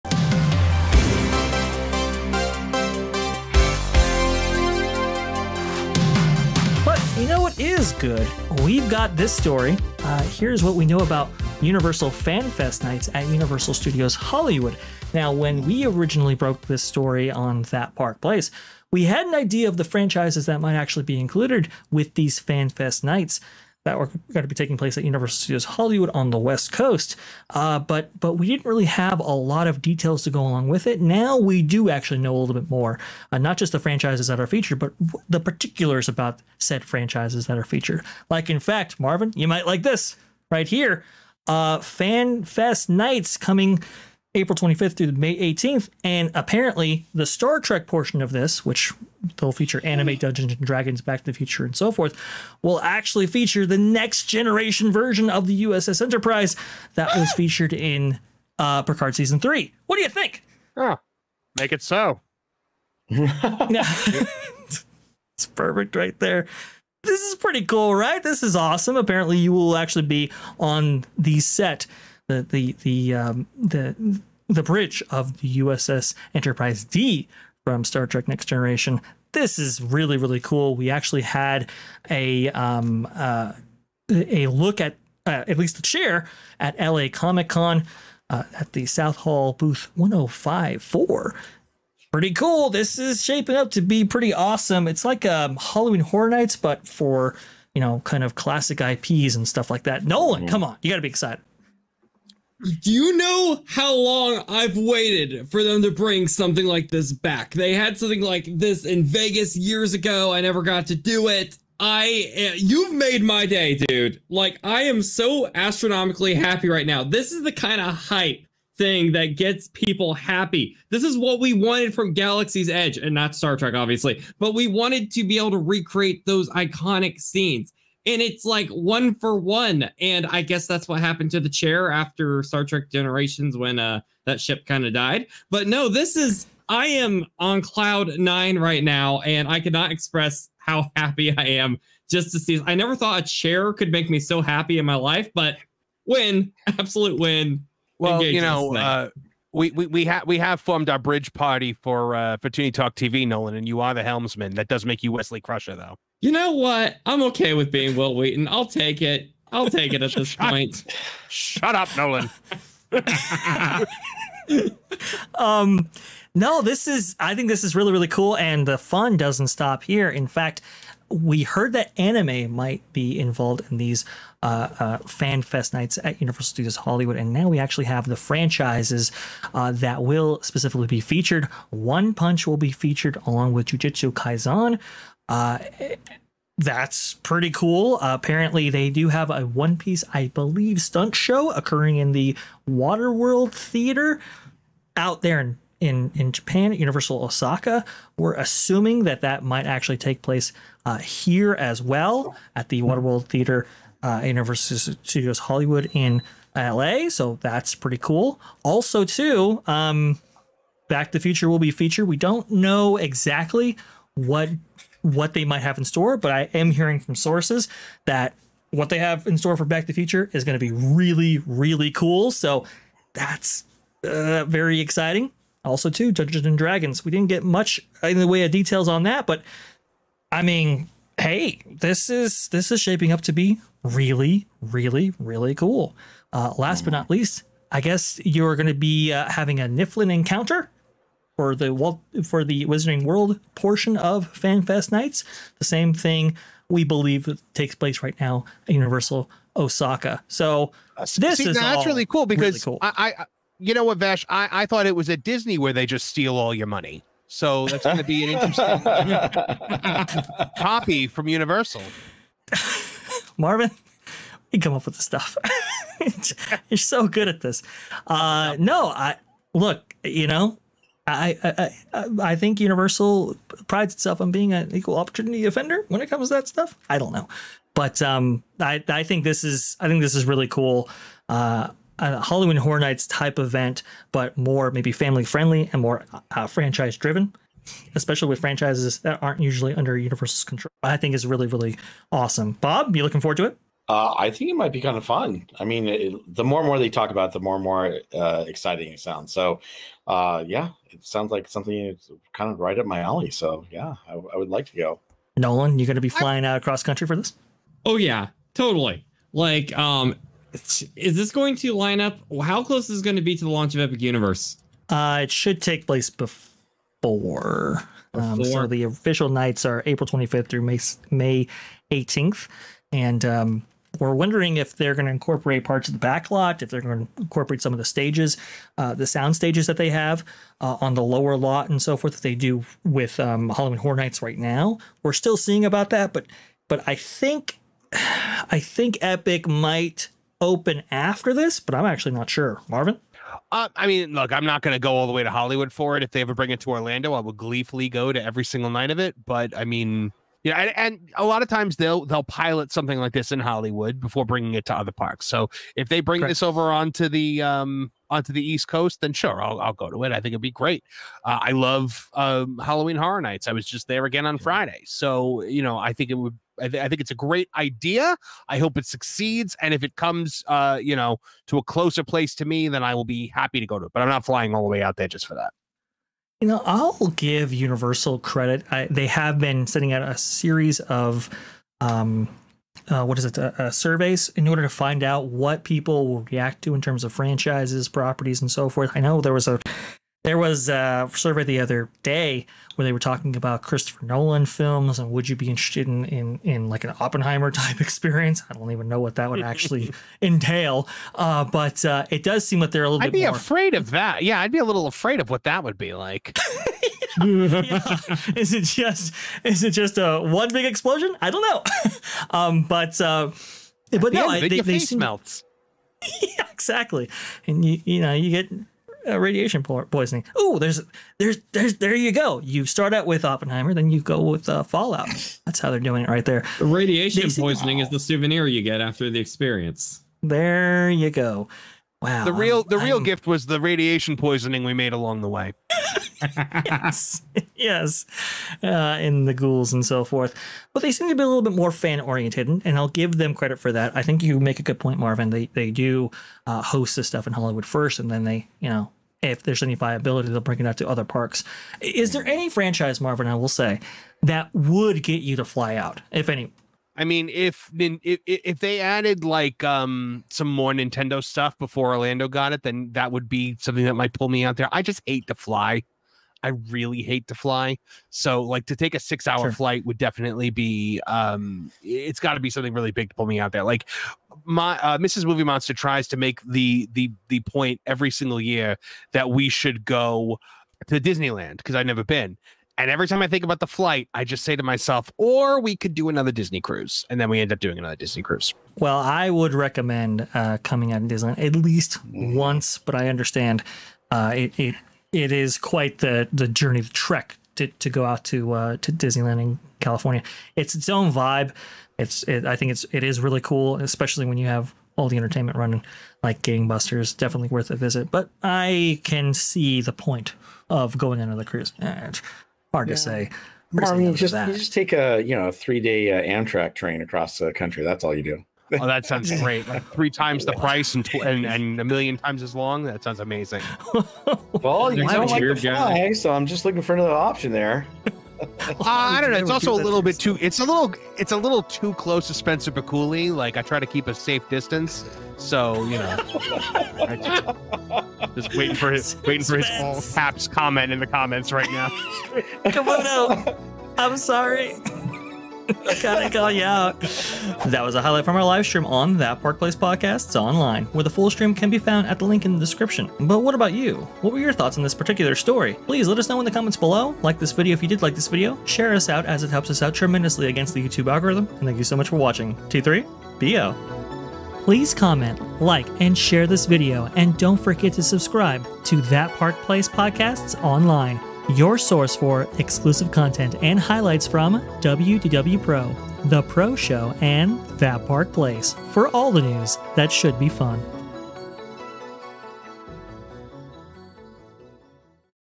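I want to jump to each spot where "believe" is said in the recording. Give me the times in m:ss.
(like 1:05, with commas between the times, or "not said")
3:10, 4:06.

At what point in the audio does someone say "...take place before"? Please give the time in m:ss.
5:15.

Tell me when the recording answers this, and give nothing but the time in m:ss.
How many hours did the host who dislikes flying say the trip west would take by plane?
7:48.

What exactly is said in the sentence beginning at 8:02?
And every time I think about the flight, I just say to myself, or we could do another Disney cruise.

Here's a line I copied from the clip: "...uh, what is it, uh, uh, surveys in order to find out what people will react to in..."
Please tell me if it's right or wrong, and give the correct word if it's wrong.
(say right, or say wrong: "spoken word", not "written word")
right.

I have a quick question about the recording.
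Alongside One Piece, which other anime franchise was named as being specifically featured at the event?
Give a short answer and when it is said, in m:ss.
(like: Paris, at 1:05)
Jujutsu Kaisen, at 3:03.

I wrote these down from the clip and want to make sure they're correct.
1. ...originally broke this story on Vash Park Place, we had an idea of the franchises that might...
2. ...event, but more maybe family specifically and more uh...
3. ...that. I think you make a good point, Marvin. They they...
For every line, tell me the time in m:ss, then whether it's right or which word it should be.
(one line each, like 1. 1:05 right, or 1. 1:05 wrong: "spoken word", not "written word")
1. 0:15 wrong: "That", not "Vash"
2. 4:43 wrong: "friendly", not "specifically"
3. 7:23 right.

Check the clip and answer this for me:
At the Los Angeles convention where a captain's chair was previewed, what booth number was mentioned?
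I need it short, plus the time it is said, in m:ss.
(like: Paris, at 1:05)
1054, at 1:29.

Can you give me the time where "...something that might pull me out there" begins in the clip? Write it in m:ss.
7:43.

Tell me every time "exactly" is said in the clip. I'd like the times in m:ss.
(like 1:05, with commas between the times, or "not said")
3:32, 6:56.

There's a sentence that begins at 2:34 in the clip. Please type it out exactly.
That does make you Wesley Crusher, though you know what?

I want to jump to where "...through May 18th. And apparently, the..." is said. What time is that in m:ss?
0:44.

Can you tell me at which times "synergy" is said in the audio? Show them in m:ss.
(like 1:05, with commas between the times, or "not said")
not said.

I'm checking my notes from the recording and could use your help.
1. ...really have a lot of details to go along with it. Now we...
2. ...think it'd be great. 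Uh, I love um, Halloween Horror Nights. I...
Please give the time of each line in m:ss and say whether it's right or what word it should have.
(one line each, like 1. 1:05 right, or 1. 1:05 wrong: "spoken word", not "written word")
1. 0:28 right
2. 6:00 right.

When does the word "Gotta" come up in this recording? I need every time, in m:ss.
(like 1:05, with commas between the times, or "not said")
9:06.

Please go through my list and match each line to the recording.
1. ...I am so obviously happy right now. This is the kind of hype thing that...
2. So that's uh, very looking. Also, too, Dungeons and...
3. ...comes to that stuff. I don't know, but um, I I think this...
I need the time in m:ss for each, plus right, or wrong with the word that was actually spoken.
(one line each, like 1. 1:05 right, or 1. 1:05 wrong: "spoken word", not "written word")
1. 1:54 wrong: "astronomically", not "obviously"
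2. 3:42 wrong: "exciting", not "looking"
3. 4:36 right.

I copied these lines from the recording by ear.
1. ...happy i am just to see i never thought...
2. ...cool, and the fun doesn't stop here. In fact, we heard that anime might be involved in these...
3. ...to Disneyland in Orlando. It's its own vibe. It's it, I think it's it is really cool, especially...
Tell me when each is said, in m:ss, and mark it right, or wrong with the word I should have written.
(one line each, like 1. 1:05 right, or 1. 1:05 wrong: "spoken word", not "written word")
1. 2:20 right
2. 2:48 right
3. 8:18 wrong: "California", not "Orlando".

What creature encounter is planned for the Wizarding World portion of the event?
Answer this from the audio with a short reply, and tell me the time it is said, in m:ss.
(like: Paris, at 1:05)
Niffler, at 3:59.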